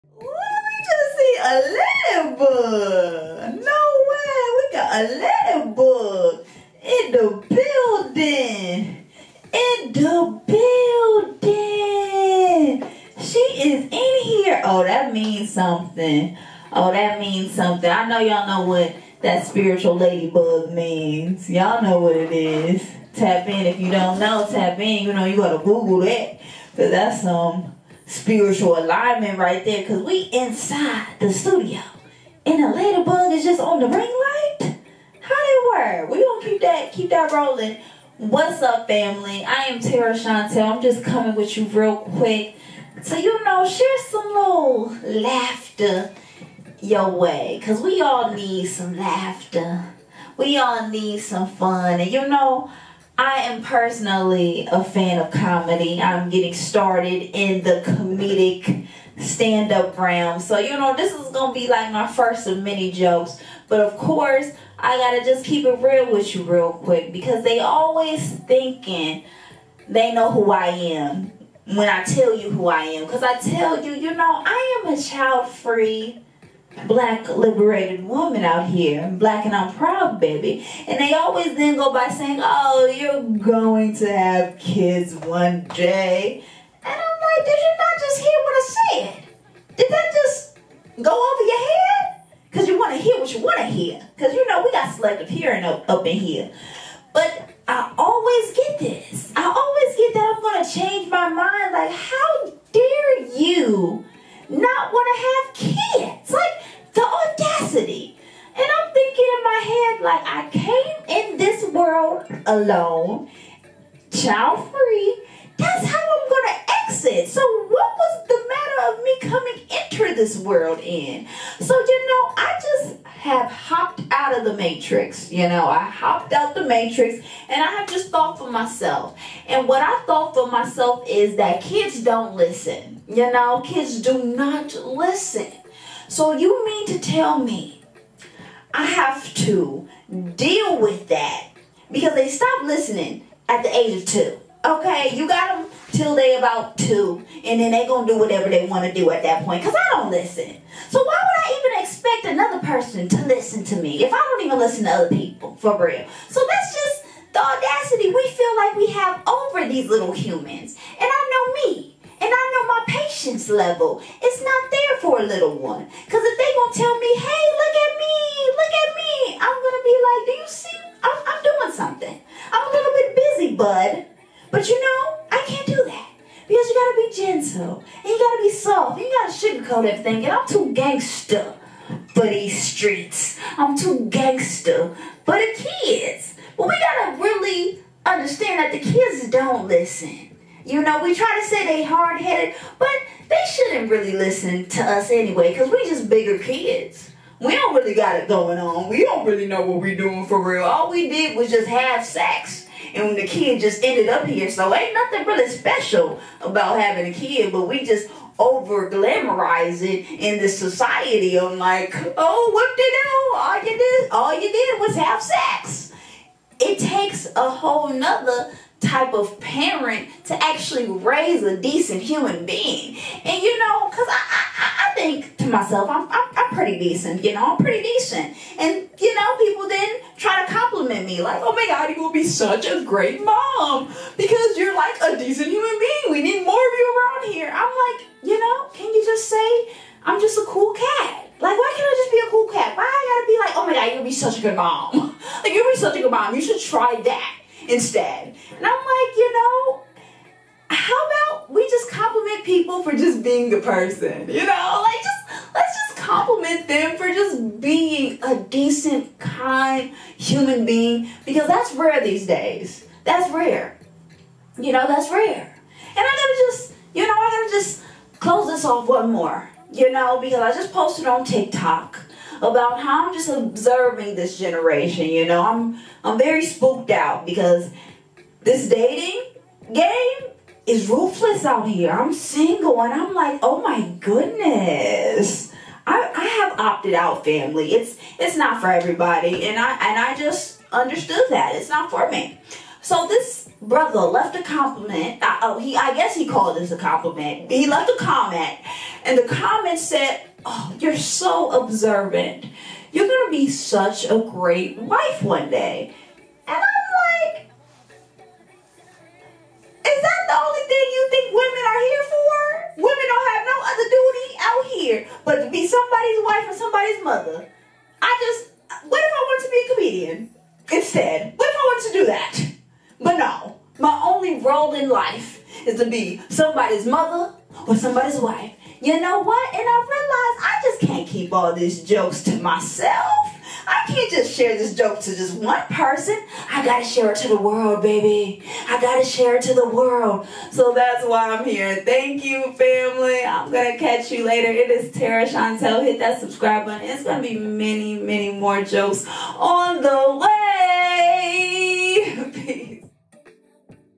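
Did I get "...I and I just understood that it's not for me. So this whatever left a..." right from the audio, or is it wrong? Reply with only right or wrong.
wrong.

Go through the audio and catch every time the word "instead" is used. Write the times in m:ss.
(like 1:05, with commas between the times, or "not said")
4:07, 5:20.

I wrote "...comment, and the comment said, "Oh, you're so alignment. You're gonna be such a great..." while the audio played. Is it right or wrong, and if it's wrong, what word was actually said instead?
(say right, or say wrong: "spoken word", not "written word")
wrong: "observant", not "alignment".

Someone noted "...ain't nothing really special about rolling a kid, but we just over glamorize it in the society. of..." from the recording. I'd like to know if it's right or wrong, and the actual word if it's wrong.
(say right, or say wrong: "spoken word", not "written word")
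wrong: "having", not "rolling".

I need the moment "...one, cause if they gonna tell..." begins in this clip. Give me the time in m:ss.
2:45.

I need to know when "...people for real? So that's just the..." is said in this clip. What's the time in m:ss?
2:35.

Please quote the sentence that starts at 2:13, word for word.
You know, kids do not listen.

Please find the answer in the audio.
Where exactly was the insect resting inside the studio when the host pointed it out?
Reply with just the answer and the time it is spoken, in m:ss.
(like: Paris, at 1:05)
On the ring light, at 0:33.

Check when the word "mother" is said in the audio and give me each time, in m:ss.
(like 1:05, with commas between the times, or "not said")
5:17, 5:26.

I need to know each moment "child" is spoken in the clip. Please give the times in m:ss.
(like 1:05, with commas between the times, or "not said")
1:14, 1:54.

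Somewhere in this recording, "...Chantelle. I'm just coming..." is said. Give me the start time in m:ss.
0:40.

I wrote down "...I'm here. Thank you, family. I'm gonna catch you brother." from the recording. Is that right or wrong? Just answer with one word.
wrong.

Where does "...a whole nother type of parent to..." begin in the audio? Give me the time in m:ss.
3:37.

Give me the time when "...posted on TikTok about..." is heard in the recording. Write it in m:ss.
4:30.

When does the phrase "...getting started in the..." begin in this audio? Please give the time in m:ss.
0:56.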